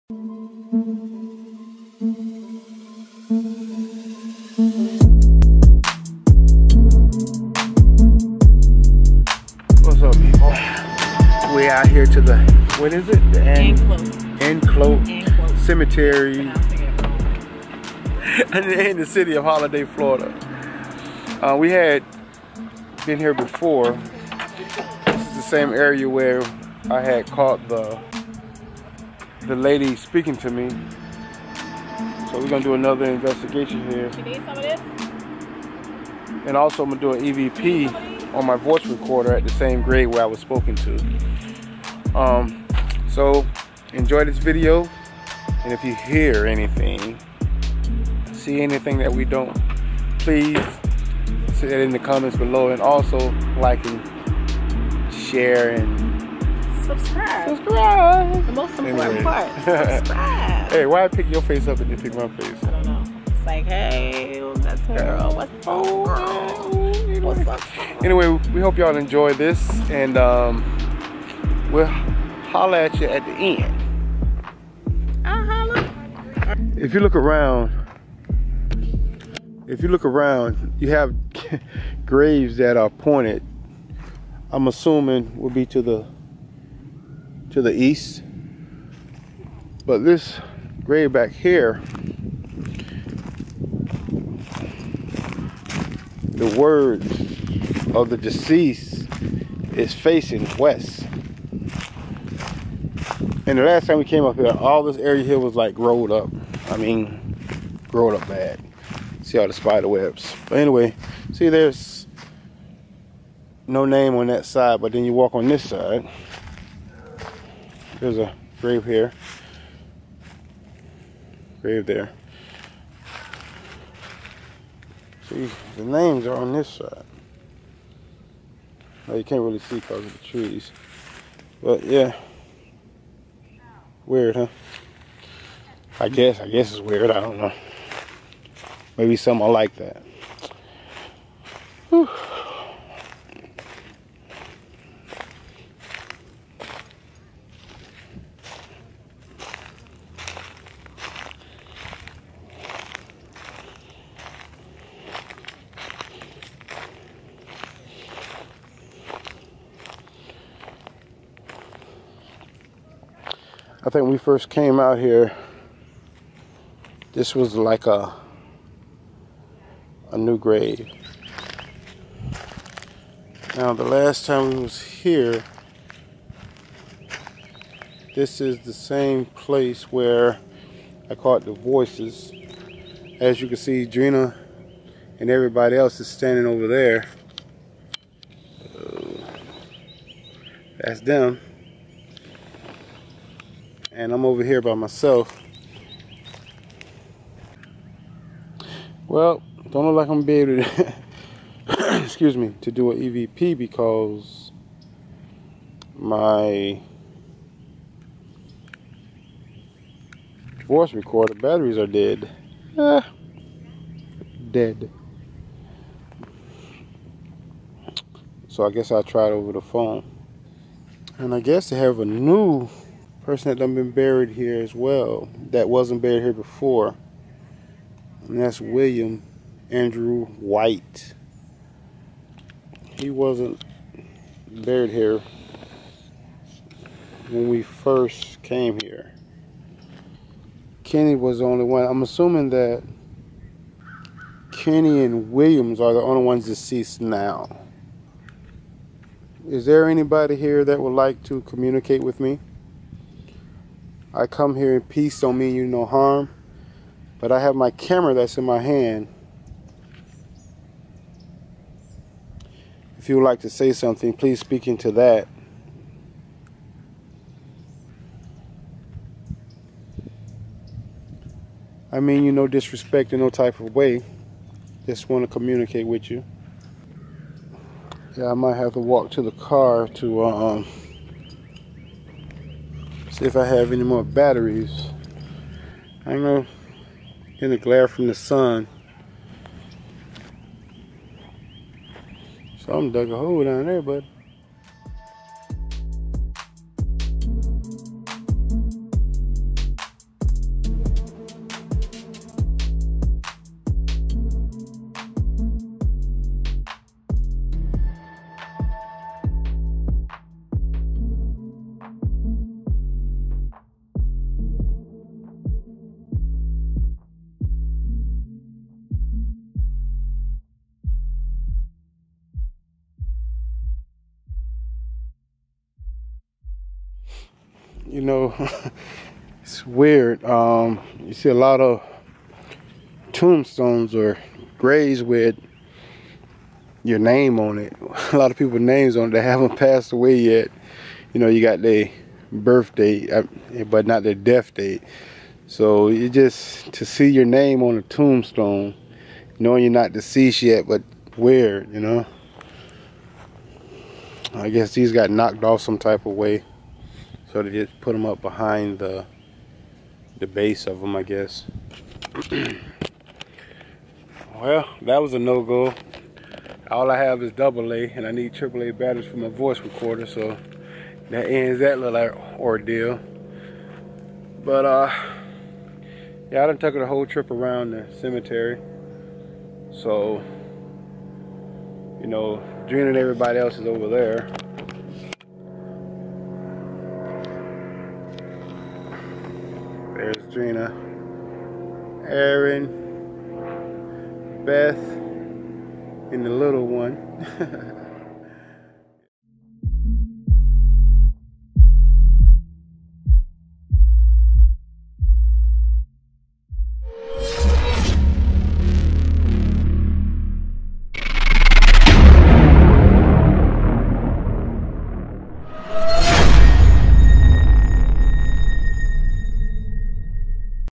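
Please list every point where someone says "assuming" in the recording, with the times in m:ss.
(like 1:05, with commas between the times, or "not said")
1:24, 4:02.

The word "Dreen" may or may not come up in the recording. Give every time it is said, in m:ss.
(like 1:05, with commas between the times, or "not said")
6:22.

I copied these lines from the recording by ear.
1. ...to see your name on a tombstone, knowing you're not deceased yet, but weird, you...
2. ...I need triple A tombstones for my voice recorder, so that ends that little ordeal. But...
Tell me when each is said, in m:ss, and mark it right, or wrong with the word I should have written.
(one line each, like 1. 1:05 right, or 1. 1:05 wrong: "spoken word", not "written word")
1. 5:46 right
2. 6:08 wrong: "batteries", not "tombstones".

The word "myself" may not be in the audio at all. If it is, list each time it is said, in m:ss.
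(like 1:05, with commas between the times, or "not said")
3:14.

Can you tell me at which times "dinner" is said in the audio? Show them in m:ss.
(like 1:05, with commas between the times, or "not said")
not said.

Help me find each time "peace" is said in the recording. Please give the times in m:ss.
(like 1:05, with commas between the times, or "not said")
4:14.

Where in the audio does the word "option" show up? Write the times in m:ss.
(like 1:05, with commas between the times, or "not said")
not said.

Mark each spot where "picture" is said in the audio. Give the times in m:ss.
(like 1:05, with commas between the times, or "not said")
not said.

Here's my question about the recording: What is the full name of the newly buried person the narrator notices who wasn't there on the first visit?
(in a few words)
William Andrew White.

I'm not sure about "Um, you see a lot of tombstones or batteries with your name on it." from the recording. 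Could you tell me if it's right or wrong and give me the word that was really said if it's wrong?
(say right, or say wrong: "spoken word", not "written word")
wrong: "graves", not "batteries".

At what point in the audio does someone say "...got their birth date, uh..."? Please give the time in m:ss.
5:41.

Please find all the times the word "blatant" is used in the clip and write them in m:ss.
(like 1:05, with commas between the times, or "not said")
not said.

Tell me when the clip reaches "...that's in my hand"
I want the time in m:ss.
4:18.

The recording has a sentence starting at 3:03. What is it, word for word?
As you can see, Drena and everybody else is standing over there.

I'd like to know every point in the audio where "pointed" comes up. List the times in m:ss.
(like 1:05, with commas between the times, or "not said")
1:22.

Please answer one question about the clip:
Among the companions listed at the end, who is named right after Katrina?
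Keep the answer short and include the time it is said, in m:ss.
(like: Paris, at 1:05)
Aaron, at 6:32.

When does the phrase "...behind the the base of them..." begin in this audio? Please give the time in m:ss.
5:58.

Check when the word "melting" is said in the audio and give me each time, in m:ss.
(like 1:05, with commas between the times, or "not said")
not said.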